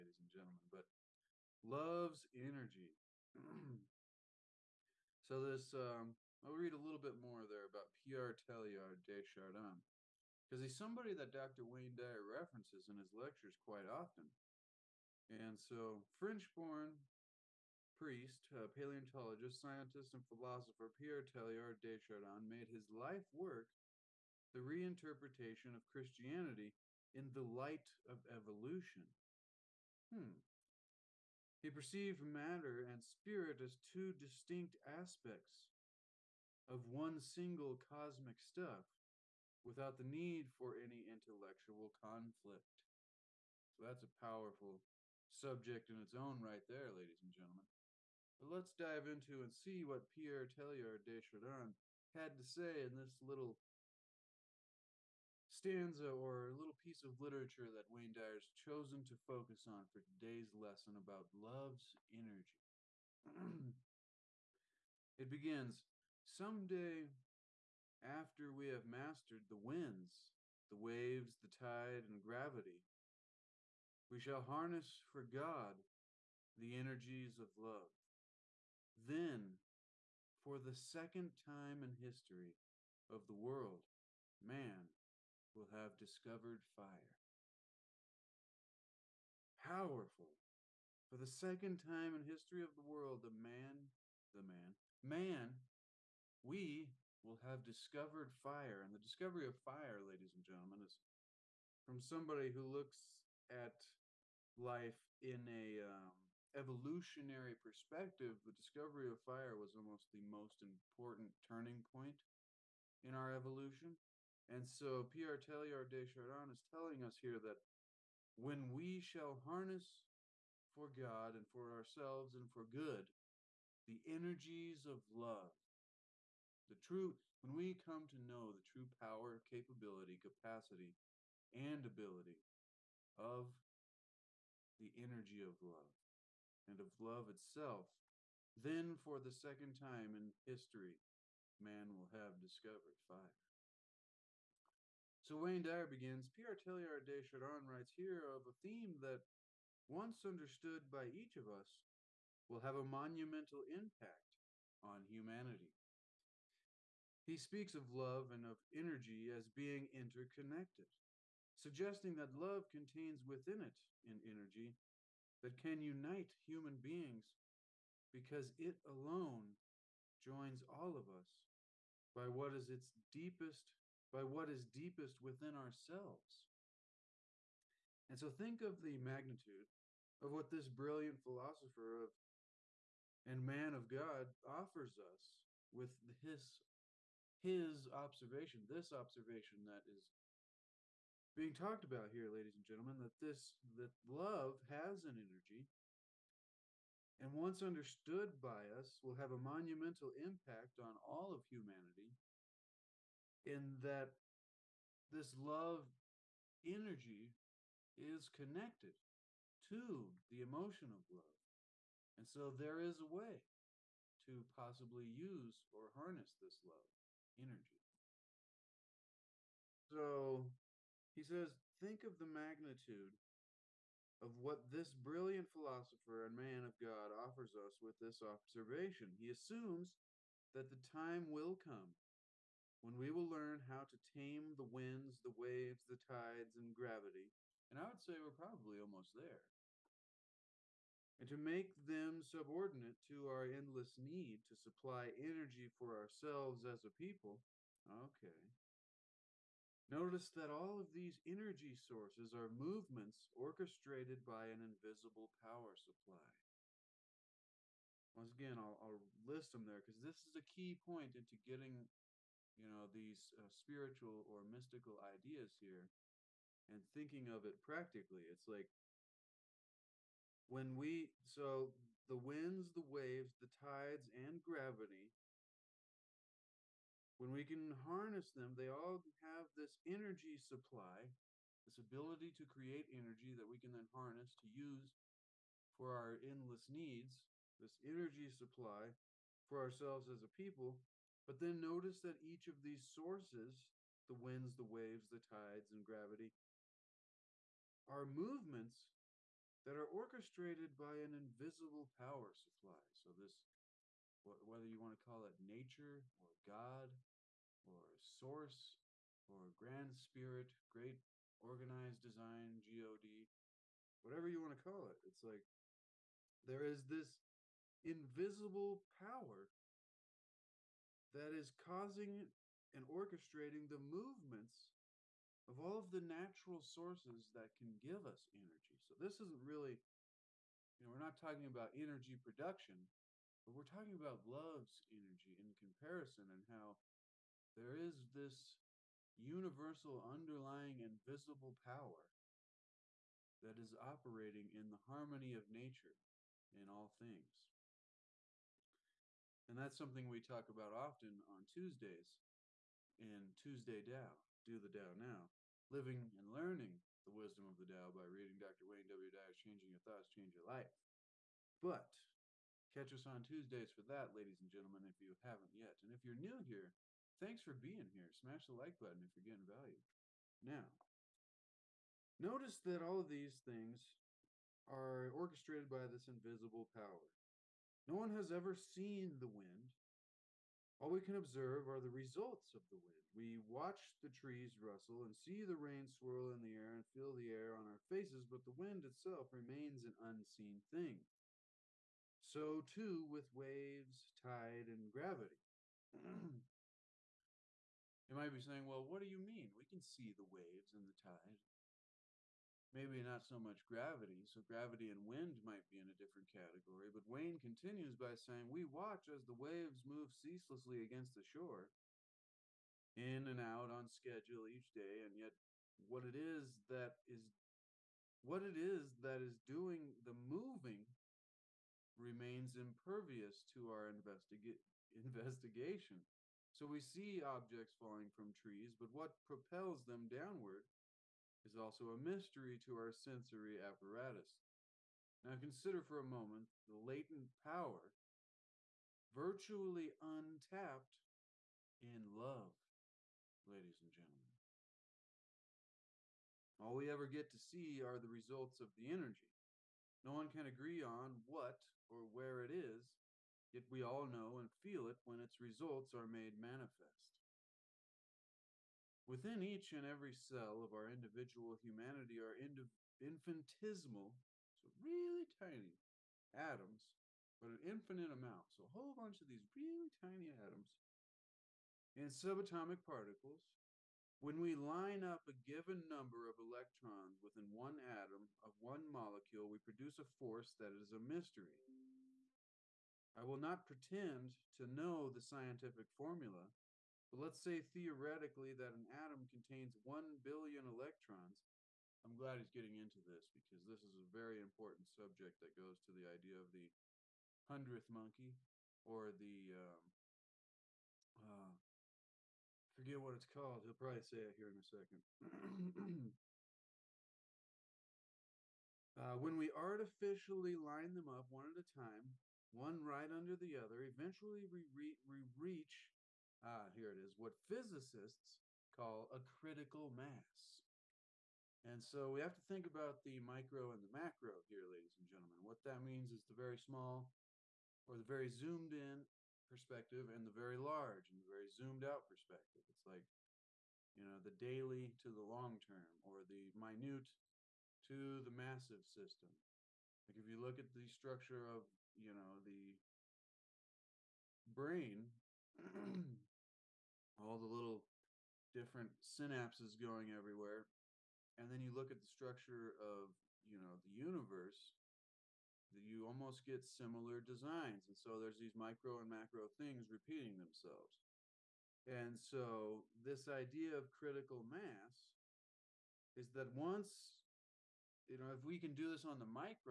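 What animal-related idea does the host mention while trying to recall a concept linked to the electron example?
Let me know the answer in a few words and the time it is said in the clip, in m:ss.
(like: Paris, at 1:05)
Hundredth monkey, at 8:17.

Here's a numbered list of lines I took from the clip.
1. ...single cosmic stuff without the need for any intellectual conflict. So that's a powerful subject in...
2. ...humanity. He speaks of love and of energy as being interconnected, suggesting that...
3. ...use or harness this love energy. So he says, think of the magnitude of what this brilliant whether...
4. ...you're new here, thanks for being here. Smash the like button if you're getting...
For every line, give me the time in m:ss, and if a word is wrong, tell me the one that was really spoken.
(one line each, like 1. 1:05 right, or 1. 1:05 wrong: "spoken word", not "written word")
1. 0:37 right
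2. 2:35 right
3. 3:35 wrong: "philosopher", not "whether"
4. 6:06 right.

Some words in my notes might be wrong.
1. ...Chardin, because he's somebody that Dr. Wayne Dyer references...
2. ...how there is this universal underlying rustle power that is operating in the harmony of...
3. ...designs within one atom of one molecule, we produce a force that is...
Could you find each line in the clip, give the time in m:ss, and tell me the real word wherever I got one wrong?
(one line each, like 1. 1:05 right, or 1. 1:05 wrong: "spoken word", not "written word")
1. 0:09 right
2. 5:36 wrong: "invisible", not "rustle"
3. 7:56 wrong: "electrons", not "designs".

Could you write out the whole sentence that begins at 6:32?
So, too, with waves, tide, and gravity.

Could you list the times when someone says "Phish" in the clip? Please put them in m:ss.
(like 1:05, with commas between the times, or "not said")
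not said.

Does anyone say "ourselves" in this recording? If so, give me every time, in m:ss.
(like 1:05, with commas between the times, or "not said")
2:01, 2:55, 4:05, 4:49.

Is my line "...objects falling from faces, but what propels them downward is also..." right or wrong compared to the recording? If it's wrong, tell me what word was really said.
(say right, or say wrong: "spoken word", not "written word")
wrong: "trees", not "faces".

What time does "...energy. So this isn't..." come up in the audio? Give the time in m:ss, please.
5:28.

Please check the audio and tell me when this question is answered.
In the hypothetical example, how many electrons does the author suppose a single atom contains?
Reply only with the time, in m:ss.
8:09.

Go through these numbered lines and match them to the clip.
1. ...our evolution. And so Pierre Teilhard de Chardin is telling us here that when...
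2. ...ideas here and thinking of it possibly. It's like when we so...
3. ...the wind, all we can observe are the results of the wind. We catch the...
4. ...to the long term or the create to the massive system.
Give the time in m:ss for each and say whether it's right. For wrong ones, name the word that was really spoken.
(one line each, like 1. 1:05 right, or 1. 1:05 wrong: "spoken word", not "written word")
1. 1:53 right
2. 4:25 wrong: "practically", not "possibly"
3. 6:19 wrong: "watch", not "catch"
4. 8:55 wrong: "minute", not "create".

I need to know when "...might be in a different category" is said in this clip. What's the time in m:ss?
6:45.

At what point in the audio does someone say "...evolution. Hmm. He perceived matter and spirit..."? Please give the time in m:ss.
0:28.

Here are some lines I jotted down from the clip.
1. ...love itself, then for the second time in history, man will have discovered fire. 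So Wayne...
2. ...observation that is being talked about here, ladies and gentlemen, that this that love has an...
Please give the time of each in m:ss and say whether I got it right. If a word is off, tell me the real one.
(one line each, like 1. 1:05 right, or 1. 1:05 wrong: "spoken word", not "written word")
1. 2:16 right
2. 3:08 right.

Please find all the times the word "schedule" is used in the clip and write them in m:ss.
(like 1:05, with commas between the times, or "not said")
6:53.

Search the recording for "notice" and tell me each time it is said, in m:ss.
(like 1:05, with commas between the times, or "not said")
4:09, 4:51, 6:12.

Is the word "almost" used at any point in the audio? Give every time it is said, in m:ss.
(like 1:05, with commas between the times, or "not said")
1:49, 3:58, 9:16.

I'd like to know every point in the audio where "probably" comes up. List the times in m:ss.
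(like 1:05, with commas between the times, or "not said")
3:58, 8:23.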